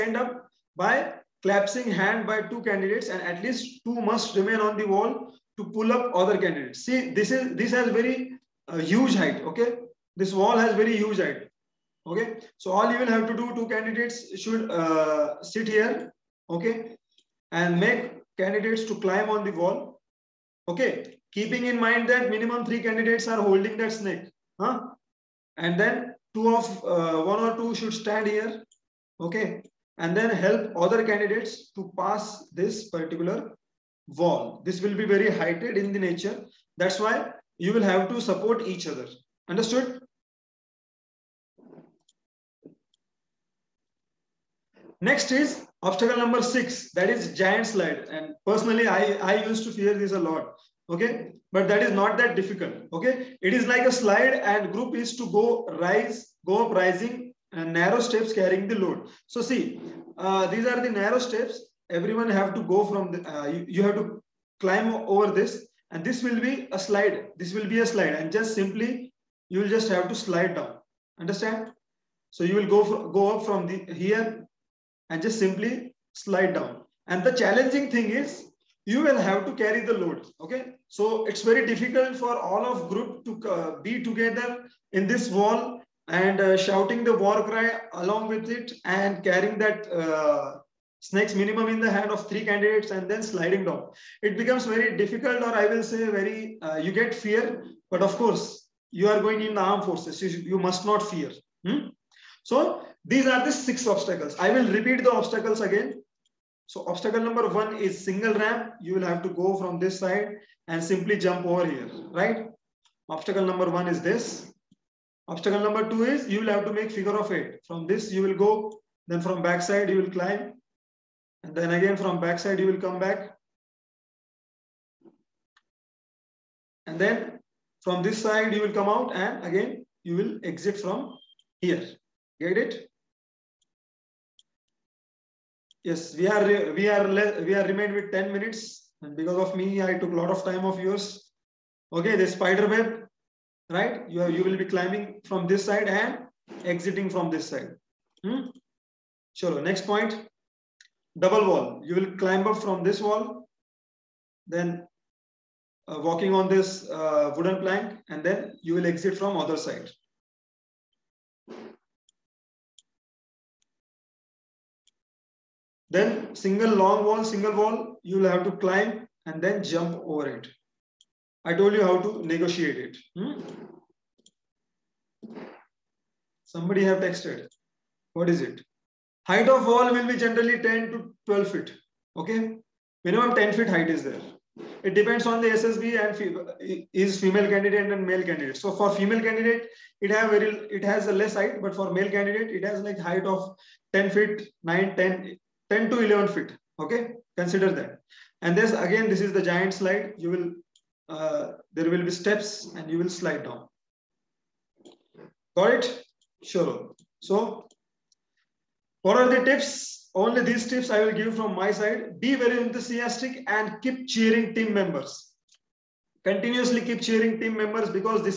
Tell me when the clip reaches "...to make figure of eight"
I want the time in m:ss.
1:56.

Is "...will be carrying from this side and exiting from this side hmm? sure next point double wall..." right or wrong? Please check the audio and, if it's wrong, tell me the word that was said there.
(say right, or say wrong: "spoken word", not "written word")
wrong: "climbing", not "carrying".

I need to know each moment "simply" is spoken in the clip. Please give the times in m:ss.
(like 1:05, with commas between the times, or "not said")
1:08, 1:15, 1:50.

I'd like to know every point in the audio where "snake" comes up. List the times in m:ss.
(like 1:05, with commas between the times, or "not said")
0:23, 1:30.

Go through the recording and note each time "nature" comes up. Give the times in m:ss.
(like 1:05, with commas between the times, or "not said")
0:35.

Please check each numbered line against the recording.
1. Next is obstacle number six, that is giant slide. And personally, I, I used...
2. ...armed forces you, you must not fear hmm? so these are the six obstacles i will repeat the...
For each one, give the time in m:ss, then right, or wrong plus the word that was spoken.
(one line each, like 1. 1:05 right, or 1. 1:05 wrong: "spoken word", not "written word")
1. 0:45 right
2. 1:39 right.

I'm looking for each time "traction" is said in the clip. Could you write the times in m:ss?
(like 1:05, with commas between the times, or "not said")
not said.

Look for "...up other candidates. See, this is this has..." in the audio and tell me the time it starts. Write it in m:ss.
0:05.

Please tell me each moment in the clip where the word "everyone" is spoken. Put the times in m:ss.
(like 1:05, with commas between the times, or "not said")
1:01.